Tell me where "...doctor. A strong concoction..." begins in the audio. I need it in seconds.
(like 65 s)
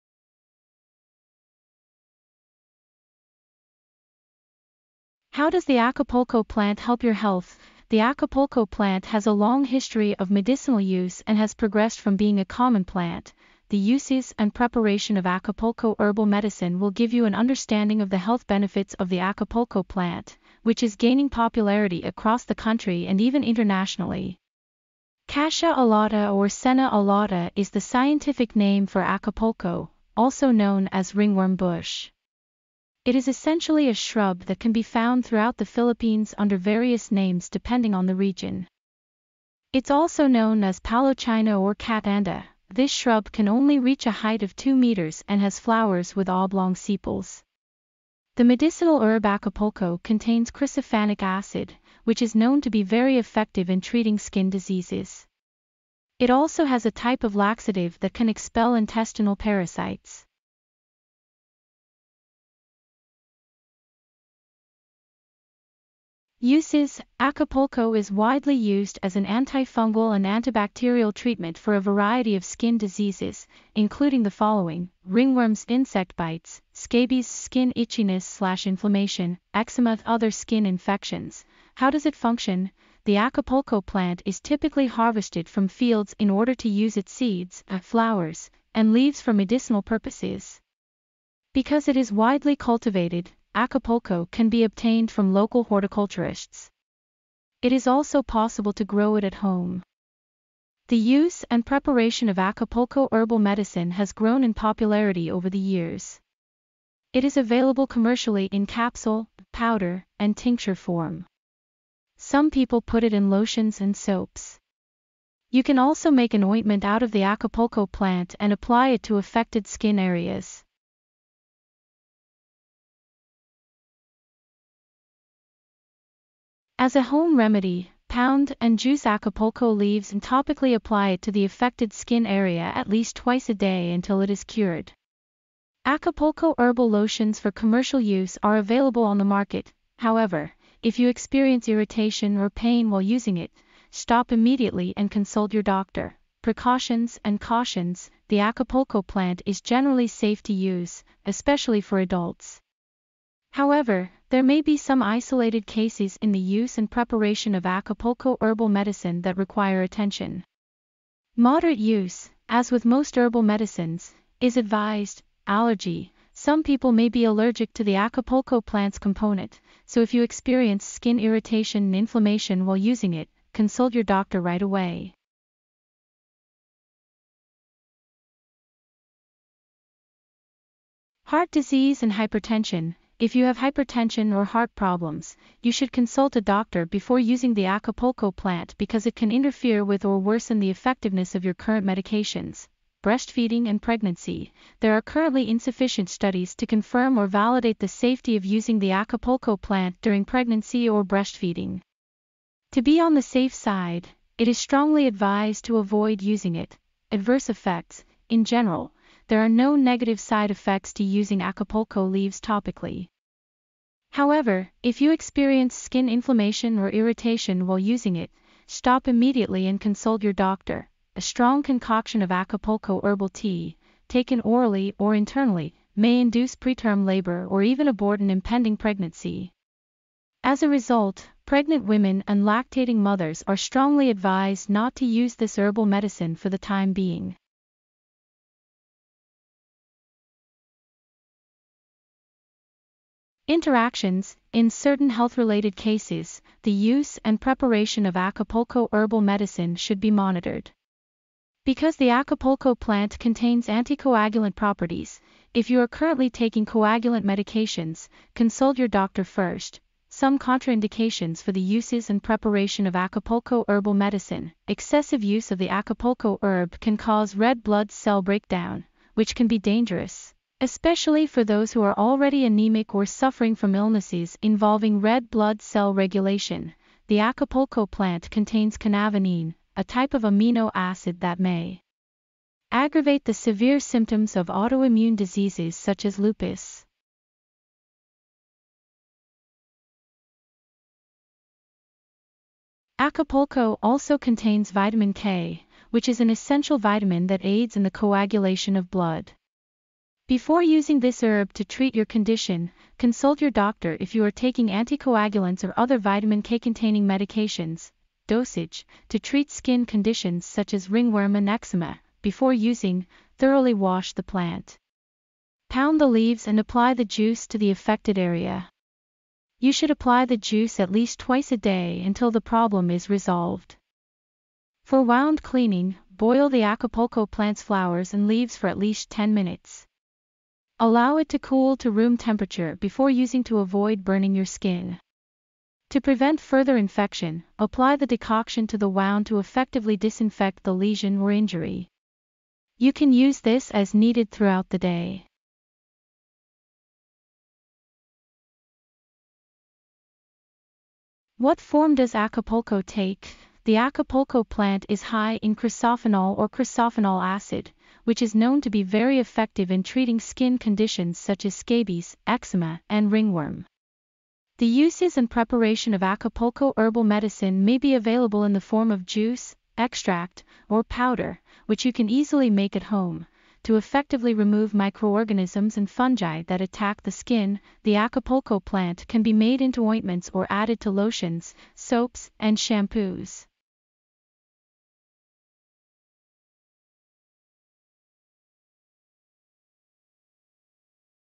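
220 s.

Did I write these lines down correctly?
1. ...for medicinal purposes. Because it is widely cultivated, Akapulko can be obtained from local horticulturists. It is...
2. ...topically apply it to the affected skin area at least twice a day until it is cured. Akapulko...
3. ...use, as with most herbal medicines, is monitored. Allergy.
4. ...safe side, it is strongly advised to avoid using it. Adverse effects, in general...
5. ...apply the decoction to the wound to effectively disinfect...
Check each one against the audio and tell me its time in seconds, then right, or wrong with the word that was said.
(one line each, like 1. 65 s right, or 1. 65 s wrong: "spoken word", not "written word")
1. 89 s right
2. 130 s right
3. 161 s wrong: "advised", not "monitored"
4. 203 s right
5. 337 s right.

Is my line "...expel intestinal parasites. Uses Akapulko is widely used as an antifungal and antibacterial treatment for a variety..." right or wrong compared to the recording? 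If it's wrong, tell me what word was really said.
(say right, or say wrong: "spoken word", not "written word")
right.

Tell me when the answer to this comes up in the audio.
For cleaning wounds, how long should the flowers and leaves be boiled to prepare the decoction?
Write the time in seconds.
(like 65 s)
329 s.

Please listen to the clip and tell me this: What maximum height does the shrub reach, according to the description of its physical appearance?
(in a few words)
2 meters.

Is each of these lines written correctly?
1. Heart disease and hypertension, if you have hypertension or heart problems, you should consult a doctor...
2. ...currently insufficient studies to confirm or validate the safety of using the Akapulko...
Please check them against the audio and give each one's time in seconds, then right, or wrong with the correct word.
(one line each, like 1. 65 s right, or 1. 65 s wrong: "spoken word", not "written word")
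1. 181 s right
2. 195 s right.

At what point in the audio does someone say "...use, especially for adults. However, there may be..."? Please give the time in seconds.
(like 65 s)
150 s.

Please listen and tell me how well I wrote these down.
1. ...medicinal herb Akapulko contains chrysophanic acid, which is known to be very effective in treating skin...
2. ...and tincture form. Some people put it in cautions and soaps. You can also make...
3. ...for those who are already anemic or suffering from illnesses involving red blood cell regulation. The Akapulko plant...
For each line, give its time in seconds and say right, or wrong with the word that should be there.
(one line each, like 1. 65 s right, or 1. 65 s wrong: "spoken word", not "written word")
1. 48 s right
2. 110 s wrong: "lotions", not "cautions"
3. 271 s right.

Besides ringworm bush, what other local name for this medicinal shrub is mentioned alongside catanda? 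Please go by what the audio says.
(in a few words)
palochina.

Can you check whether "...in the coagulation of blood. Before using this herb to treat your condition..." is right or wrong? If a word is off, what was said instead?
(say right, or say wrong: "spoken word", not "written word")
right.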